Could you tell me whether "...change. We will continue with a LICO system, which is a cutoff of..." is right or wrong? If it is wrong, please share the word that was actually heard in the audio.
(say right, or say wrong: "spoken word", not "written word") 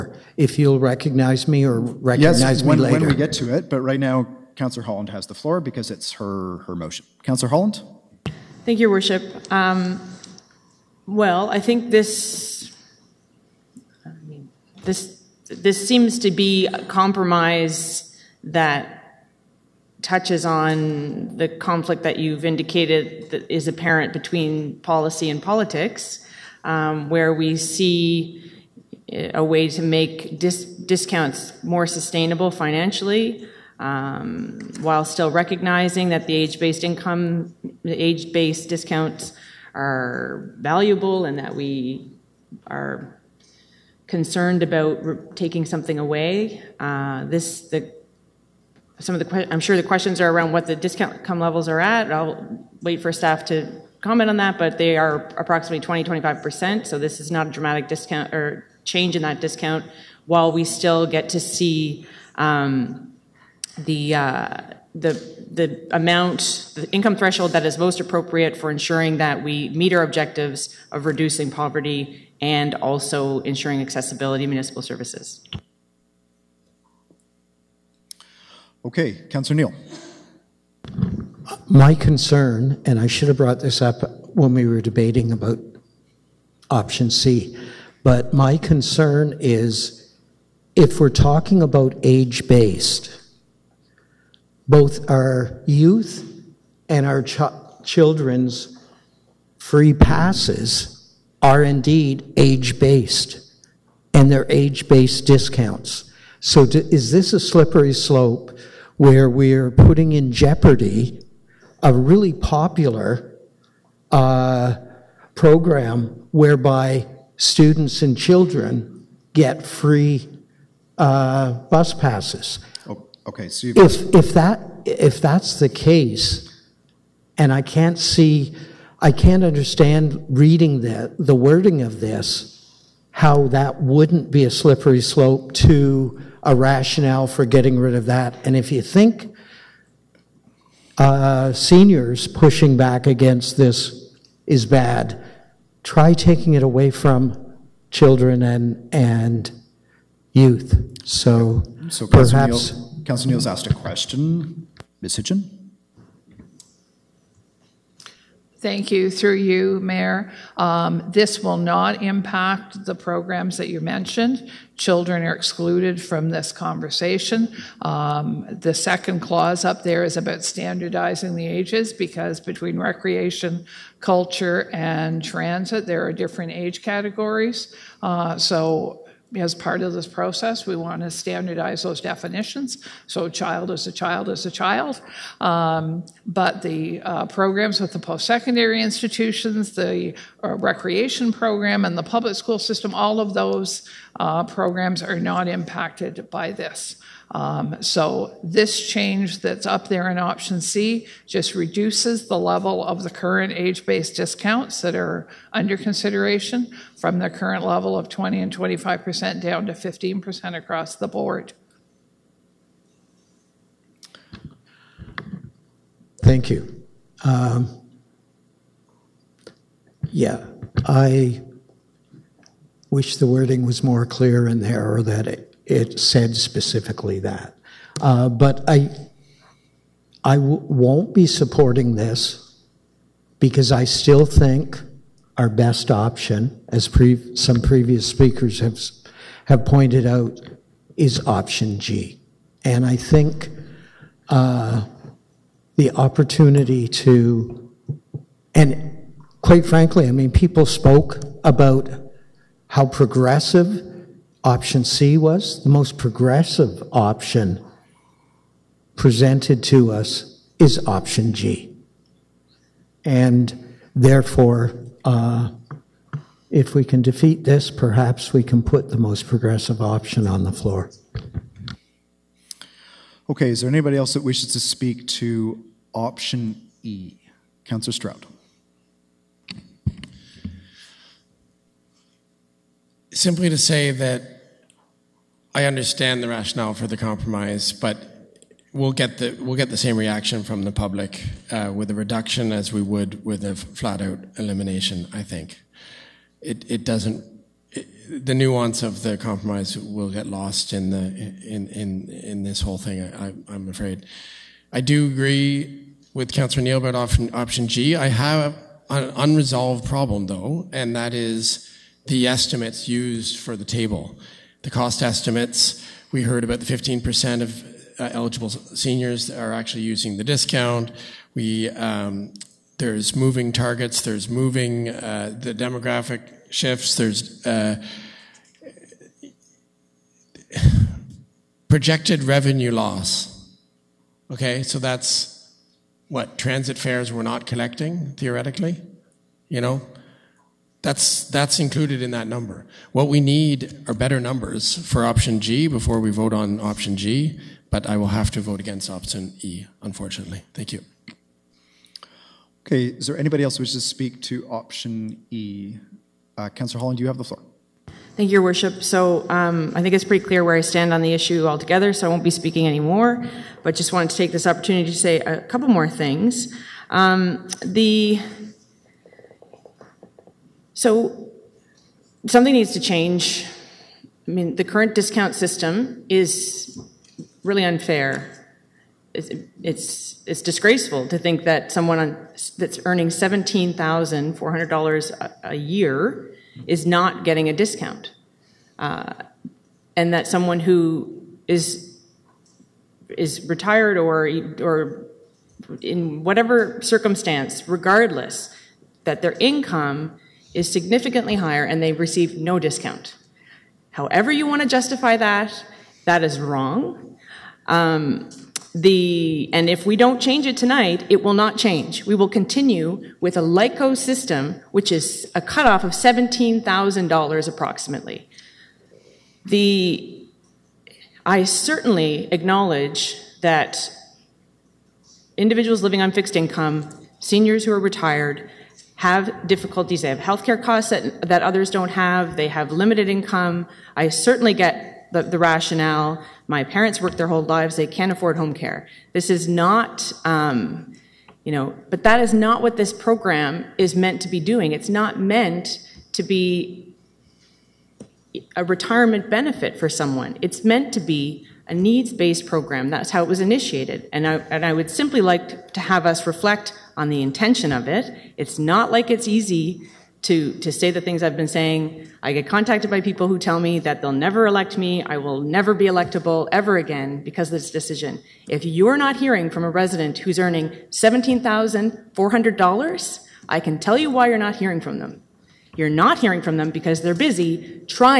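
right.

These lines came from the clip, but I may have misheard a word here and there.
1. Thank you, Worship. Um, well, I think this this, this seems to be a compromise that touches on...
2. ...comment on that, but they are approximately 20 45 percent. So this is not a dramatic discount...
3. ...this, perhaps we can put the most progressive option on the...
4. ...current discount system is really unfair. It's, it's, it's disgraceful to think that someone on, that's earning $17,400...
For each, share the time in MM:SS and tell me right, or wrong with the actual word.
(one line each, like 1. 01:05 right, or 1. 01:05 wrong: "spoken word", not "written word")
1. 00:08 right
2. 00:54 wrong: "25", not "45"
3. 04:27 right
4. 06:14 right.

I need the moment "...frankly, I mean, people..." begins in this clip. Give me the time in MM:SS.
04:09.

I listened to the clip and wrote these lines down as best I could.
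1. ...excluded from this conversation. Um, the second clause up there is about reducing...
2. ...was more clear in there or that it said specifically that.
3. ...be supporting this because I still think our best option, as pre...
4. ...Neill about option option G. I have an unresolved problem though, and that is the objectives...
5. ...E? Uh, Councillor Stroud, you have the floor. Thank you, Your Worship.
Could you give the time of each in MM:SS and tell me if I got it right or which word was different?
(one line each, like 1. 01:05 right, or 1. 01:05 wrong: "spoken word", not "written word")
1. 02:45 wrong: "standardizing", not "reducing"
2. 03:43 right
3. 03:51 right
4. 05:06 wrong: "estimates", not "objectives"
5. 05:55 wrong: "Holland", not "Stroud".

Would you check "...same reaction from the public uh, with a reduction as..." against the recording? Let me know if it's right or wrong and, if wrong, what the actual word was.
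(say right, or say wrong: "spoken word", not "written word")
right.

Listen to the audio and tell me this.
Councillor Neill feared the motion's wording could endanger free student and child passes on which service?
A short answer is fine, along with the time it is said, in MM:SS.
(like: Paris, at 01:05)
bus, at 02:01.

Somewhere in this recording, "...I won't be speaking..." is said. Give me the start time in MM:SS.
06:02.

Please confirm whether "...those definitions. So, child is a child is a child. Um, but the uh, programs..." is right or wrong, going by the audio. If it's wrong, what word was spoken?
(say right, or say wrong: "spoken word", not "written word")
right.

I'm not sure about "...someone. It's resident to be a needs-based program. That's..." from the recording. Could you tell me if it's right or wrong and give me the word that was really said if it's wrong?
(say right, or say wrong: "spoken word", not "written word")
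wrong: "meant", not "resident".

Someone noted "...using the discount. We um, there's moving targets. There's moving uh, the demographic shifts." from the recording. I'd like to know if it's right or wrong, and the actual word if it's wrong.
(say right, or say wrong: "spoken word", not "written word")
right.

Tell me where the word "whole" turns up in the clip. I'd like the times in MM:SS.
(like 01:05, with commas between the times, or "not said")
05:02, 07:17.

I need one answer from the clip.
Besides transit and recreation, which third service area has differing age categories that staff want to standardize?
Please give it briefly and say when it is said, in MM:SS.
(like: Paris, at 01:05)
culture, at 02:53.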